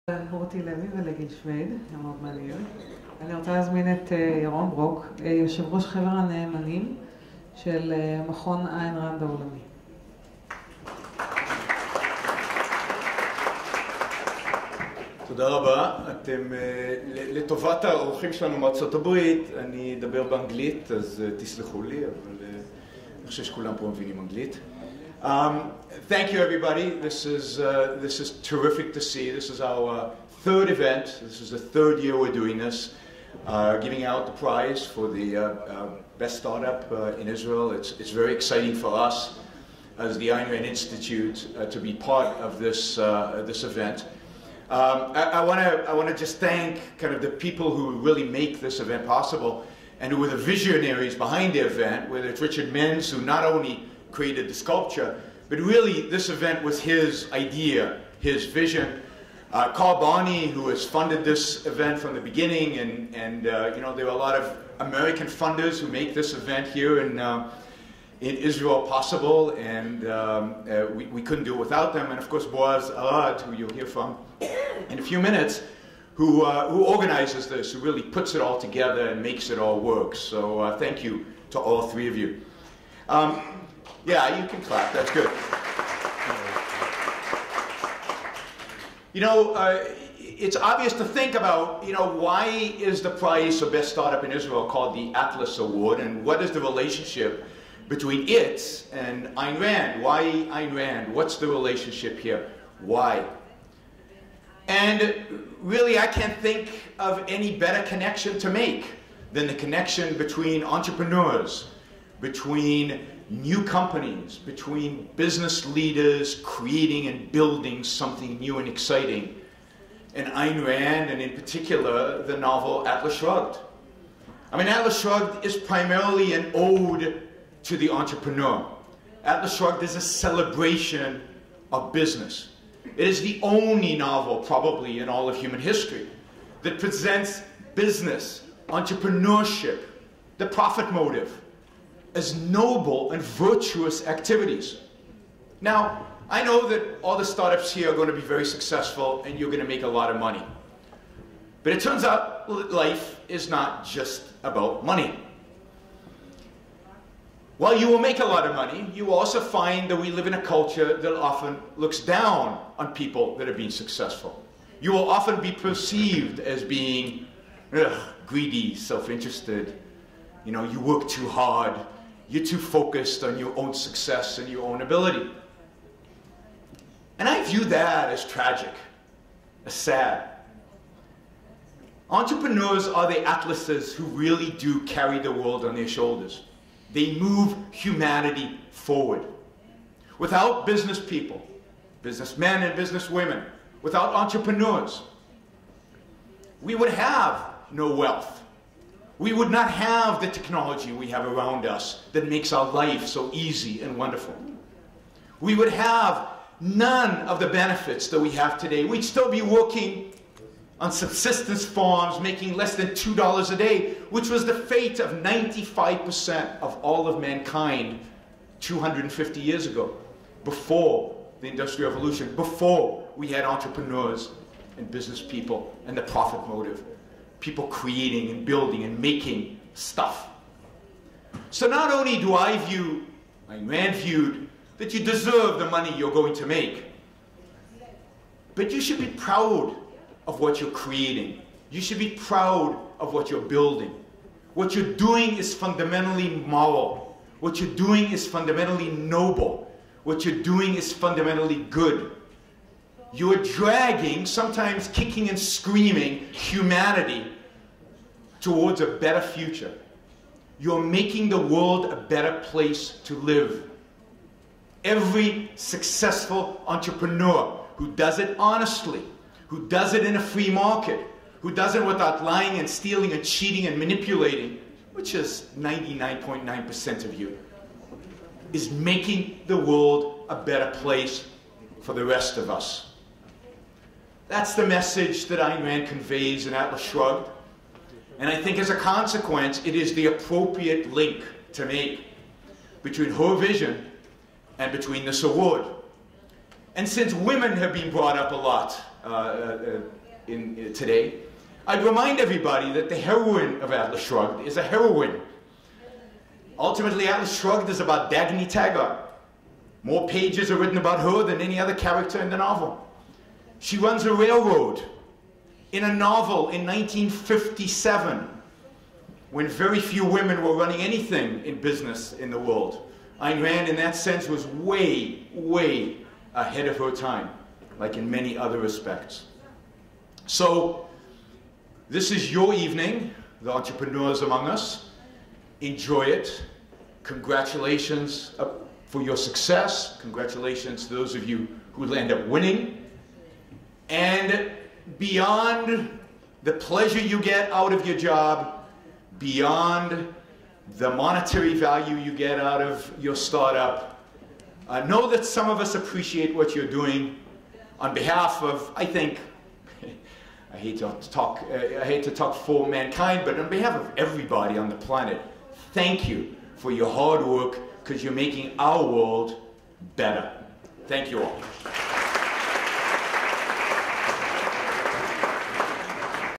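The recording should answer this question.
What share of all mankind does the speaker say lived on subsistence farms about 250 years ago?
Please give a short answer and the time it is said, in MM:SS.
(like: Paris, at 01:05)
95%, at 03:35.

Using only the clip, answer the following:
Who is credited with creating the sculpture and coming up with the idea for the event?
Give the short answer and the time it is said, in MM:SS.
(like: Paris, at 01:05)
Richard Menz, at 00:52.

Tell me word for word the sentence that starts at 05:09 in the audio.
More pages are written about her than any other character in the novel.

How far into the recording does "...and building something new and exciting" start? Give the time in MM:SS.
01:57.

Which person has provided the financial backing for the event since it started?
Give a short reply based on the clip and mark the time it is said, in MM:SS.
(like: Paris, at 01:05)
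Carl Barney, at 00:59.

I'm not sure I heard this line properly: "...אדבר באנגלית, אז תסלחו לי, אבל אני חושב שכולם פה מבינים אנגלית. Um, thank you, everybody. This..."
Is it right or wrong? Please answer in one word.
right.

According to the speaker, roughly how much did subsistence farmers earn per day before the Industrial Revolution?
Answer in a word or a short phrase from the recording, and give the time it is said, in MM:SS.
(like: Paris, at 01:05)
Less than $2, at 03:32.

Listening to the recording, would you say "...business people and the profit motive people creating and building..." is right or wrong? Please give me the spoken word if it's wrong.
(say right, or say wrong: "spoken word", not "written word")
right.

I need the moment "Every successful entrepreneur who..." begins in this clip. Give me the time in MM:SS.
04:24.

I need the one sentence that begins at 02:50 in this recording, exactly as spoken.
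You know, you work too hard you're too focused on your own success and your own ability.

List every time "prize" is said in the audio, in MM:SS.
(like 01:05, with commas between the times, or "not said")
00:34, 01:33.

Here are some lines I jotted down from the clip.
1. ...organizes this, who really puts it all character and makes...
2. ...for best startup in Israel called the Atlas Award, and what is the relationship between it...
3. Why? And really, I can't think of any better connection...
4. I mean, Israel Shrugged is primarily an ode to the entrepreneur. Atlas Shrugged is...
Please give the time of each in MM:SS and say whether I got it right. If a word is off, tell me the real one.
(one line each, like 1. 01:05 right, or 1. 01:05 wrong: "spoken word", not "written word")
1. 01:16 wrong: "together", not "character"
2. 01:33 right
3. 01:42 right
4. 02:04 wrong: "Atlas", not "Israel".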